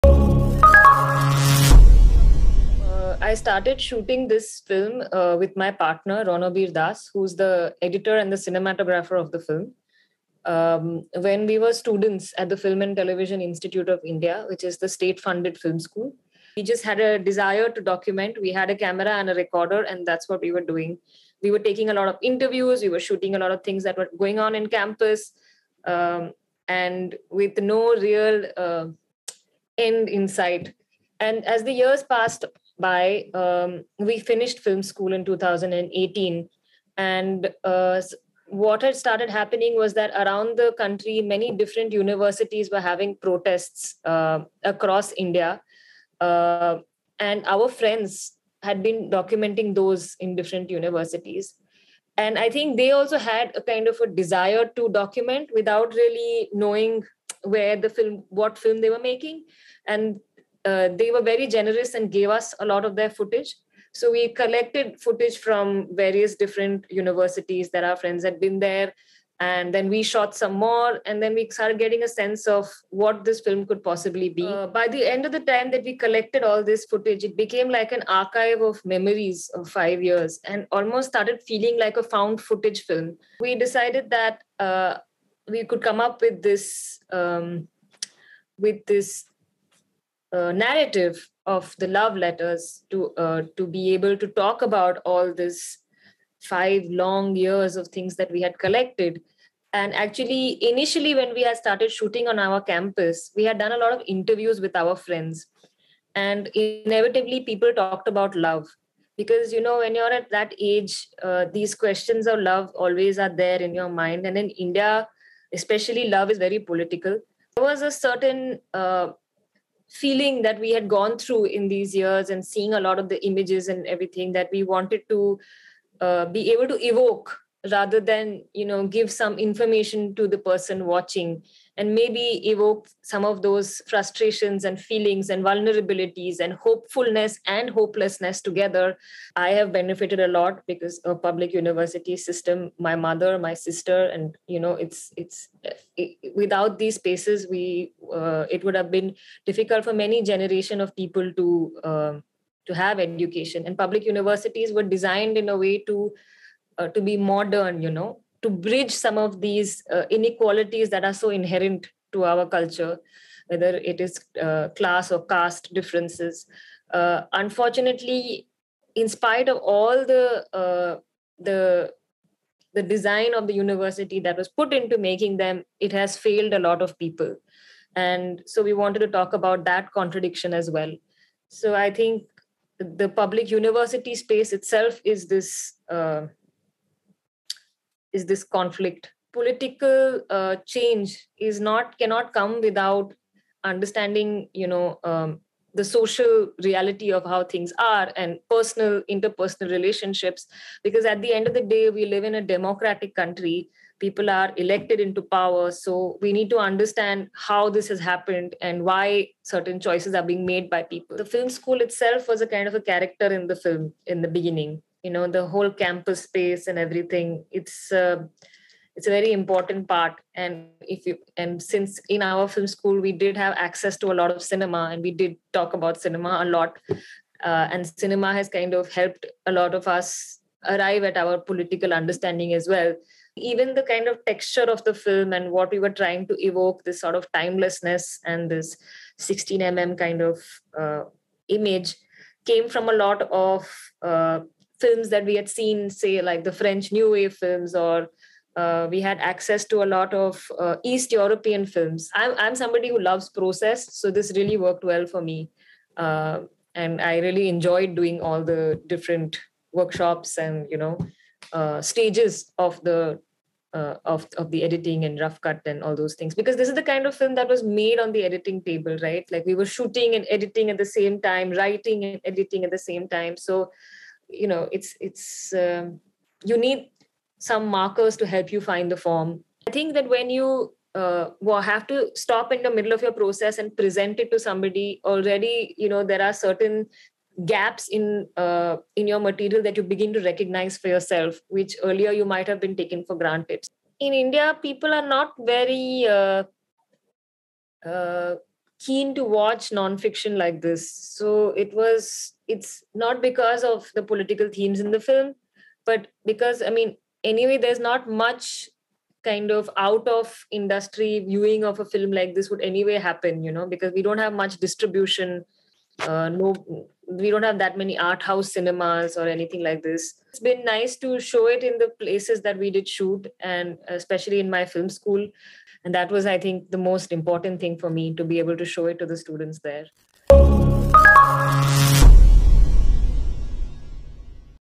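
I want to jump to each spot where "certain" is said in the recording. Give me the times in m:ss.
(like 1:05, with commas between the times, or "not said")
1:57, 3:29, 4:46.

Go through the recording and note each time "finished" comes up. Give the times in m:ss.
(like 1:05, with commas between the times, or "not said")
0:34.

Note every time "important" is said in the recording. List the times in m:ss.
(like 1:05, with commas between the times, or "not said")
3:39, 5:27.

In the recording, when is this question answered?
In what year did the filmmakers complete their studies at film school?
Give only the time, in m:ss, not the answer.
0:35.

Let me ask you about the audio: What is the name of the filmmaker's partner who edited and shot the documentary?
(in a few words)
Ranabir Das.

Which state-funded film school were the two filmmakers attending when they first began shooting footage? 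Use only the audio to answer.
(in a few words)
Film and Television Institute of India.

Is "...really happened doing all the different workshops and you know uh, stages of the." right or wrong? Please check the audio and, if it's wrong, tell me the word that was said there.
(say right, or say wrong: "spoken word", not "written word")
wrong: "enjoyed", not "happened".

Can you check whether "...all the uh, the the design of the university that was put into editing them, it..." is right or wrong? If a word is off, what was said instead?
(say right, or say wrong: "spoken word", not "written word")
wrong: "making", not "editing".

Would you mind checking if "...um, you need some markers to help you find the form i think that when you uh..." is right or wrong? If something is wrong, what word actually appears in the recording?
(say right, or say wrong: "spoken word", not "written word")
right.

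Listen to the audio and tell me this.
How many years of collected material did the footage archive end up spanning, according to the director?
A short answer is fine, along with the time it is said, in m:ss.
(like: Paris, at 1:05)
5, at 1:19.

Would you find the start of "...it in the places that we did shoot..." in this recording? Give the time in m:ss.
5:21.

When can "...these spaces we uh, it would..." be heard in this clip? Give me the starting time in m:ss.
2:26.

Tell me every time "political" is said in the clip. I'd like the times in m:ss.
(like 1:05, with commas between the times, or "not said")
1:56, 3:09, 3:51, 5:04.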